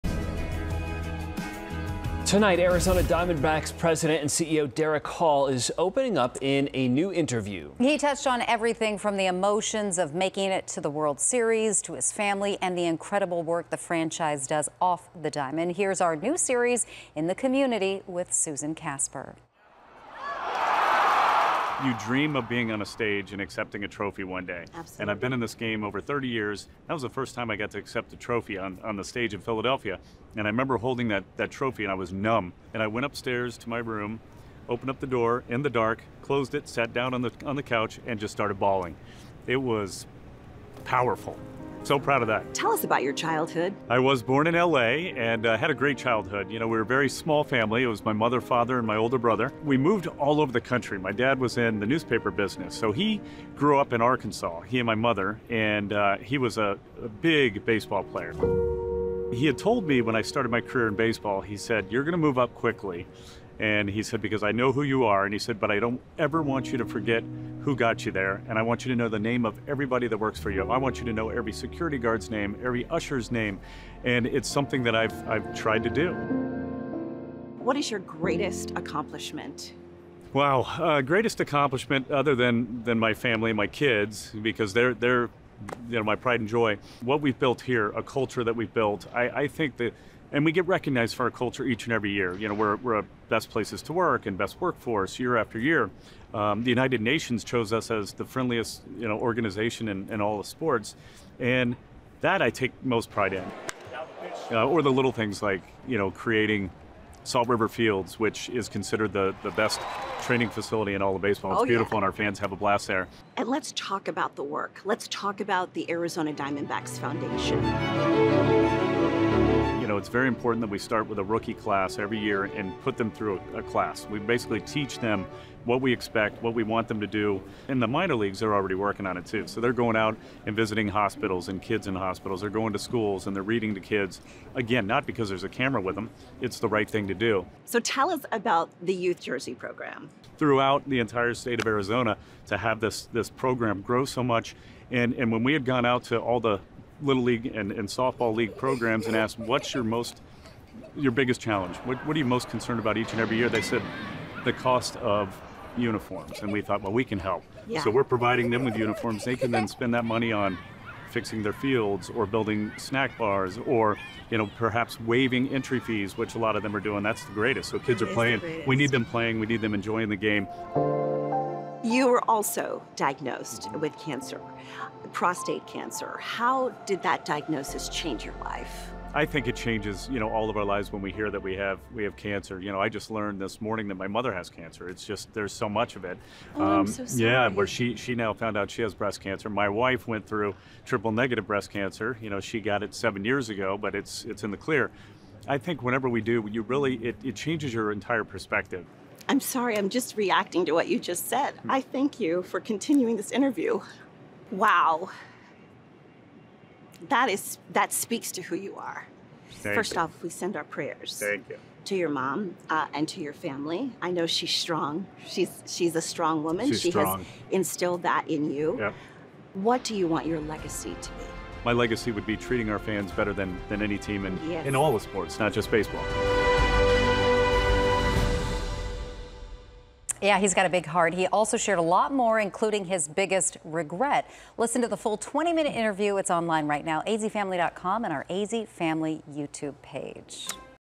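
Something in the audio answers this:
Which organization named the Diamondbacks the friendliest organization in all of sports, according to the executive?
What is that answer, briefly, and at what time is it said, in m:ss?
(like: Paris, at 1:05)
United Nations, at 1:36.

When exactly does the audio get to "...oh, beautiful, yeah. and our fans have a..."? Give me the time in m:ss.
1:51.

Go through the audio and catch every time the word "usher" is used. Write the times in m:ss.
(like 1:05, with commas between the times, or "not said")
1:12.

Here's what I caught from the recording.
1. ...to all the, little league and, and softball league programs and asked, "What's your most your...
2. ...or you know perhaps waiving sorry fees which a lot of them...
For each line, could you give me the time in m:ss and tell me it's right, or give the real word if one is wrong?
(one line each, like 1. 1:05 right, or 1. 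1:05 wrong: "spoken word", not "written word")
1. 2:26 right
2. 2:43 wrong: "entry", not "sorry".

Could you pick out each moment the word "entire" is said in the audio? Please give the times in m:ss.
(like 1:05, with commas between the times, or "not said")
2:20, 3:17.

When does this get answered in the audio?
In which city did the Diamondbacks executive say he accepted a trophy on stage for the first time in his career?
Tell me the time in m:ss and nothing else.
0:29.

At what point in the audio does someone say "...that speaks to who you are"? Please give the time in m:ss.
3:27.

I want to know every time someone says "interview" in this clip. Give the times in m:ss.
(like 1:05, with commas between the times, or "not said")
0:07, 3:23, 3:55.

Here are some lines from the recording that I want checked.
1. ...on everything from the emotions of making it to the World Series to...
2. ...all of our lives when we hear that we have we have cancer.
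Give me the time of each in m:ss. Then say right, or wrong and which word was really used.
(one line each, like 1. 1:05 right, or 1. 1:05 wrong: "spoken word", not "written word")
1. 0:08 right
2. 3:00 right.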